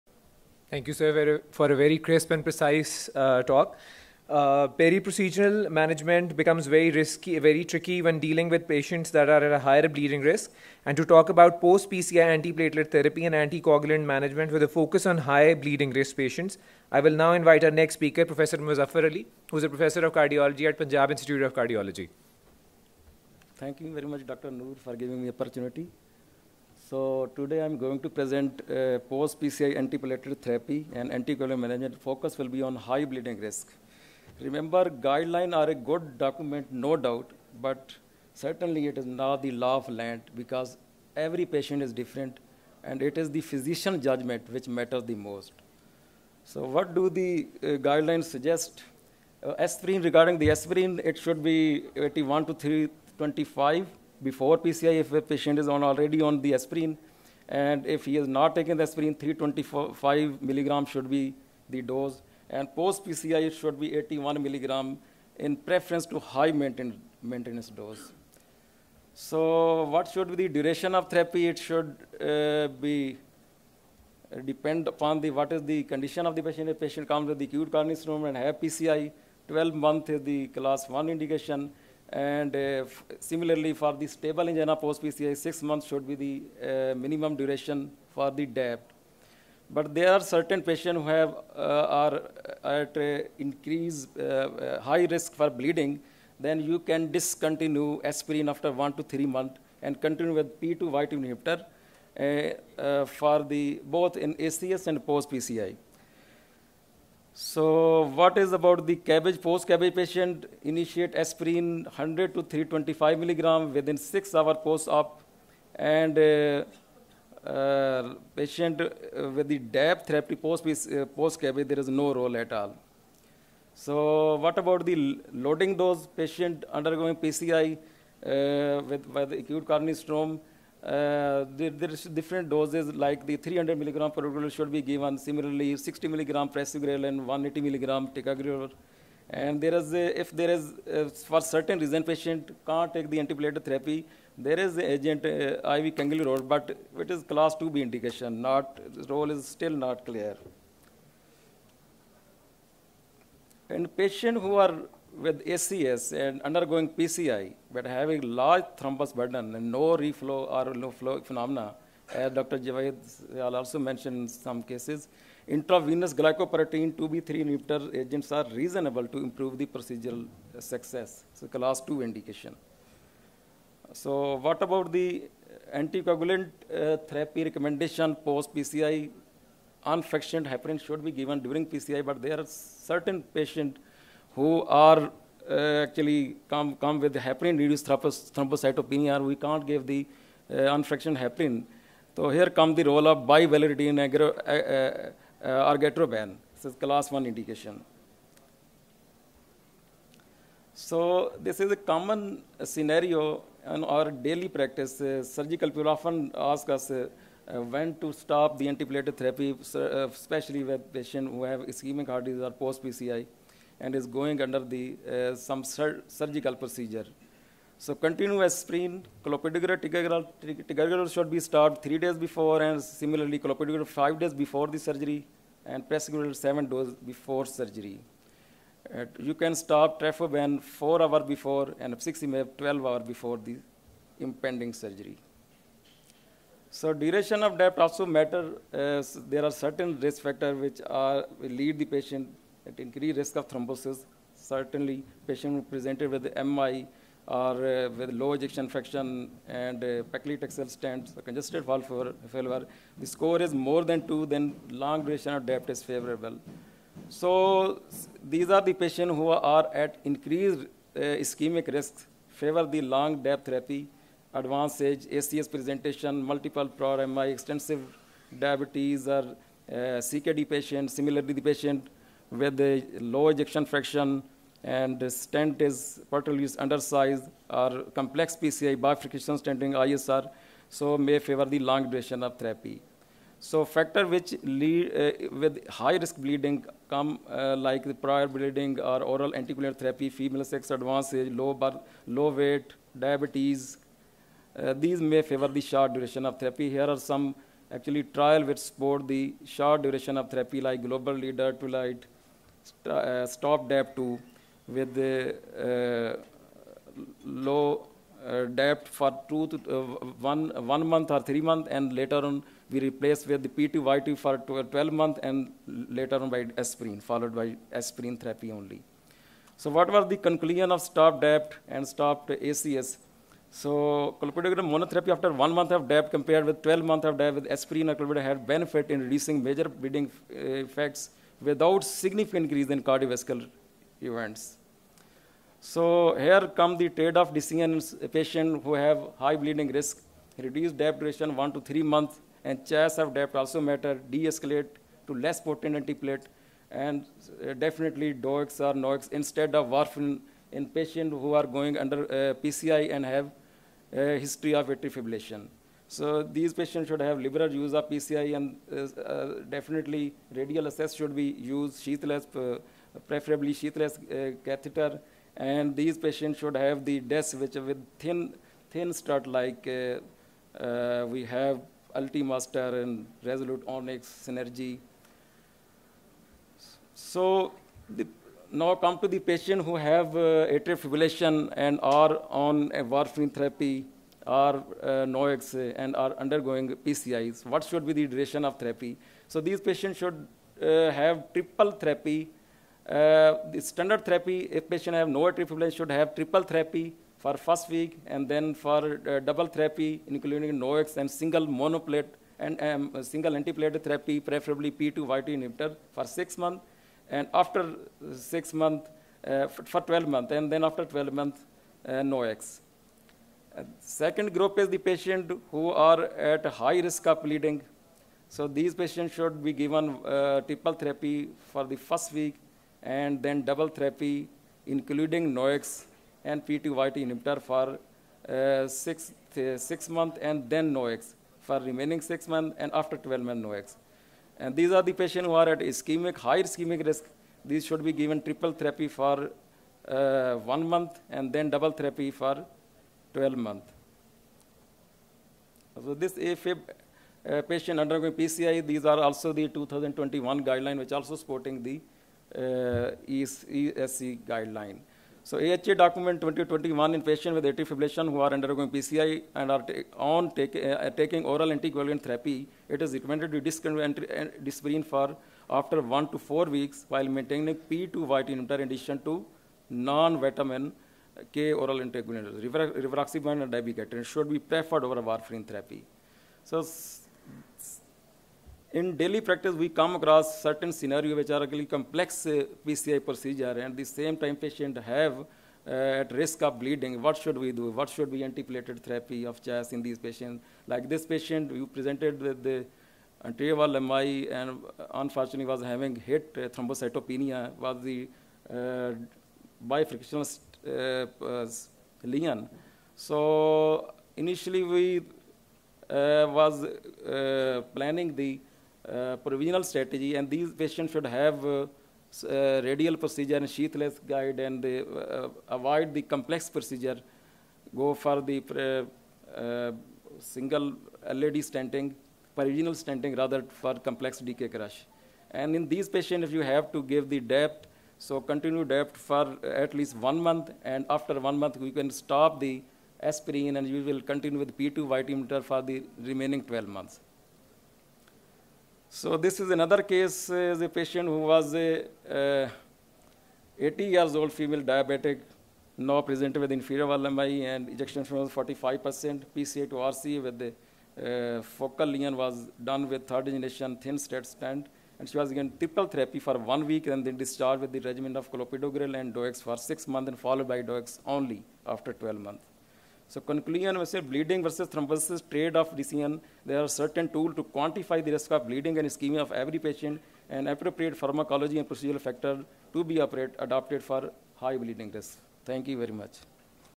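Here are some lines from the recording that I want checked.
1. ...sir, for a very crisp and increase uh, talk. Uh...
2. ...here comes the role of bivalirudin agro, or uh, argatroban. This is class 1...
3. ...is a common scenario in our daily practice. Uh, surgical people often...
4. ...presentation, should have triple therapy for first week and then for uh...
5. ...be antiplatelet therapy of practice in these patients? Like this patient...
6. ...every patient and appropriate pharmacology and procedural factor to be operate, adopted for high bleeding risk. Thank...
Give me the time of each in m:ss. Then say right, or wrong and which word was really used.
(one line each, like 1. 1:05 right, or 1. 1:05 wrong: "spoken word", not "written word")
1. 0:00 wrong: "precise", not "increase"
2. 3:12 right
3. 3:21 right
4. 6:35 wrong: "fibrillation", not "presentation"
5. 8:08 wrong: "choice", not "practice"
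6. 9:29 right.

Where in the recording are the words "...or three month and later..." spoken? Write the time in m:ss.
5:11.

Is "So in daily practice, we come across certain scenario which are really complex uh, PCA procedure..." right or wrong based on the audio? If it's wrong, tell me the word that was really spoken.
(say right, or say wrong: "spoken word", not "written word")
wrong: "PCI", not "PCA".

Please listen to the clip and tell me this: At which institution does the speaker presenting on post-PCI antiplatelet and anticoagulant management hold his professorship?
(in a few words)
Punjab Institute of Cardiology.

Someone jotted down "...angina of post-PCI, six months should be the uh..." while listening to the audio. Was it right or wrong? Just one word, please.
right.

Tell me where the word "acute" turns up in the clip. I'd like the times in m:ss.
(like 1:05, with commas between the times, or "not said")
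1:17, 2:09.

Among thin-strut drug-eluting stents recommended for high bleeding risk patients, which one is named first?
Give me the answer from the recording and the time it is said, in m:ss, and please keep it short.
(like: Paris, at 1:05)
Ultimaster, at 6:11.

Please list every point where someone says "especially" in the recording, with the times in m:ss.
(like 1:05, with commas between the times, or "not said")
3:30.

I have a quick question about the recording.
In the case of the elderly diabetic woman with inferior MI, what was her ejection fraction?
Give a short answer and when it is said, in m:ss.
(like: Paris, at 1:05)
45%, at 9:08.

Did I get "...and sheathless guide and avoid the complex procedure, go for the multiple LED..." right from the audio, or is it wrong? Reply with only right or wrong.
wrong.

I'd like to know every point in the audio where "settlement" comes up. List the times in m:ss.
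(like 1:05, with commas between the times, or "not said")
not said.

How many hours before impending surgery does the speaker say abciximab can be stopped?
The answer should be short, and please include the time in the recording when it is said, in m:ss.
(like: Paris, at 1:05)
12 hours, at 3:52.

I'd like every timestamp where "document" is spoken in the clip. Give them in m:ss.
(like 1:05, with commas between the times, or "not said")
0:36, 7:35.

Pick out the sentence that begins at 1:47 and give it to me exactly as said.
So what is about the CABG?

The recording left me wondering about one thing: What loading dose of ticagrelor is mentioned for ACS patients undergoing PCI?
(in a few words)
180 milligram.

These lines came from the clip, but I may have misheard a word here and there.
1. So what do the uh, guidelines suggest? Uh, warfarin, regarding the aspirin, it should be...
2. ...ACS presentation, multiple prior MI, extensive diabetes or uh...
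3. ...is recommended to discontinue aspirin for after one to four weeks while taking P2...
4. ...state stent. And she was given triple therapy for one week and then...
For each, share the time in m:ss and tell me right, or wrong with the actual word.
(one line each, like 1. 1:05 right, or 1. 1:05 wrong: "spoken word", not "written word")
1. 0:46 wrong: "aspirin", not "warfarin"
2. 4:25 right
3. 7:42 wrong: "maintaining", not "taking"
4. 9:13 right.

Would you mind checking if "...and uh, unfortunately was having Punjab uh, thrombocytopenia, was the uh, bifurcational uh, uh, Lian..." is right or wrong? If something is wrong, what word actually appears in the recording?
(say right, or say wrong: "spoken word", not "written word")
wrong: "HIT", not "Punjab".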